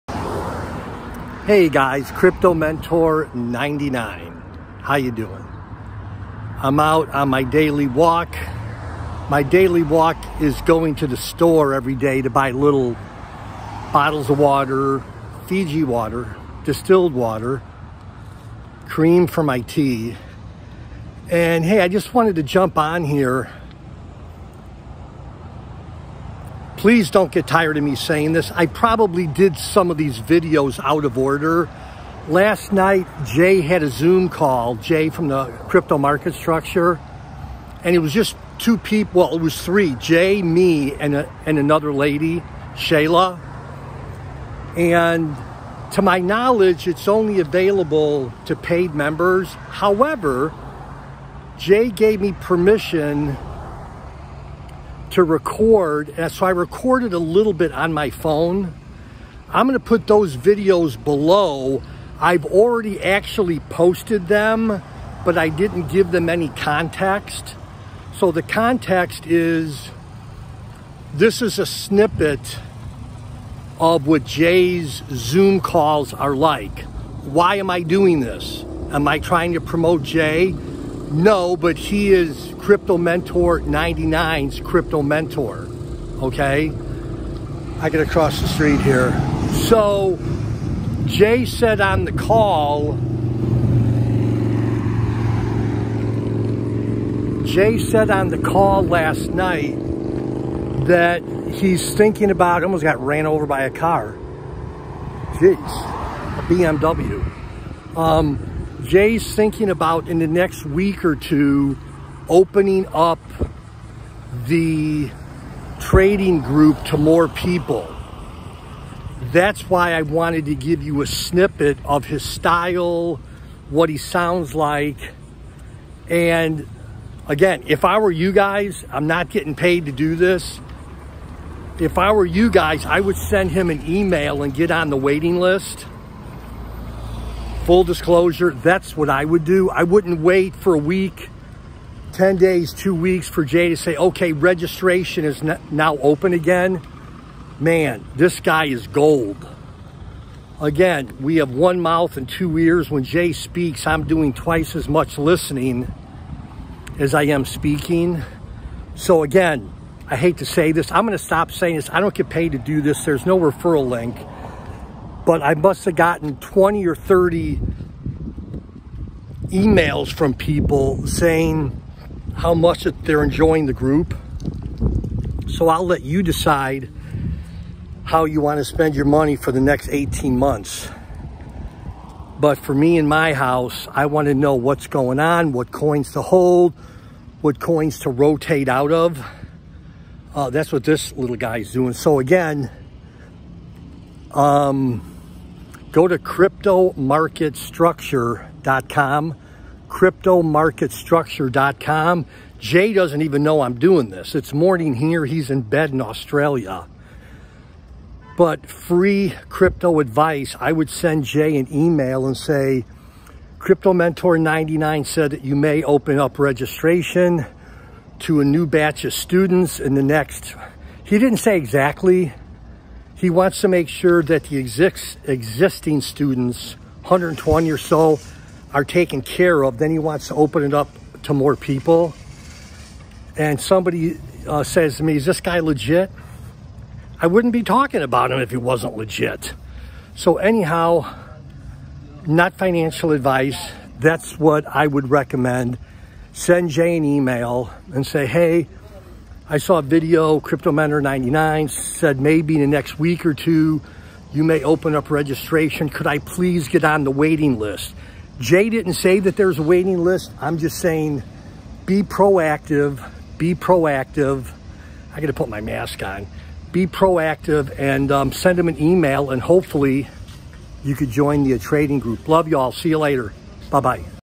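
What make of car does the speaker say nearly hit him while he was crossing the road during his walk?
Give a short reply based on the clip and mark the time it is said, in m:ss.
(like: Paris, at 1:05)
BMW, at 1:45.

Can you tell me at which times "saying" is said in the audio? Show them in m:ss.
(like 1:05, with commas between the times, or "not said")
0:27, 2:41, 2:51, 4:20.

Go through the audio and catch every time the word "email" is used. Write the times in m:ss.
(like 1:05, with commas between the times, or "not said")
2:13, 2:49, 3:31, 4:07, 4:28.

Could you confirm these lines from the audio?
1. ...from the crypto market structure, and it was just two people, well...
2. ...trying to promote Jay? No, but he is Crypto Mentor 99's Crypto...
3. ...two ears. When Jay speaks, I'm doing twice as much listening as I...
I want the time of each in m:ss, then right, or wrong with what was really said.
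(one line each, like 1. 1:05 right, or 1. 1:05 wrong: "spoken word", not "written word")
1. 0:35 right
2. 1:19 right
3. 2:32 right.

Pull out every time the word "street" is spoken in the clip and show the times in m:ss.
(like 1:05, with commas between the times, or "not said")
1:28.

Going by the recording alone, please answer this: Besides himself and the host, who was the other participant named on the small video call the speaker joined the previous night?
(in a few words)
Shayla.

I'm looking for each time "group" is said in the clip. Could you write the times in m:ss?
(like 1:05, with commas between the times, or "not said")
1:56, 2:53, 4:31.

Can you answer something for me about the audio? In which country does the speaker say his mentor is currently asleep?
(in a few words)
Australia.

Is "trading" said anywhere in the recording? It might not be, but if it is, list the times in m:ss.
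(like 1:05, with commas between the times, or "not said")
1:55, 4:31.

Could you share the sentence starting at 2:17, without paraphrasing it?
Full disclosure, that's what I would do.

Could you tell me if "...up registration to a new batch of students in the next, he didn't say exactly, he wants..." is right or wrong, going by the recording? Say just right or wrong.
right.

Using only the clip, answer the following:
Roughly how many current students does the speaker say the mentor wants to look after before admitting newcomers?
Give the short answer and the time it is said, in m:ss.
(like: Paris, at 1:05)
120, at 3:47.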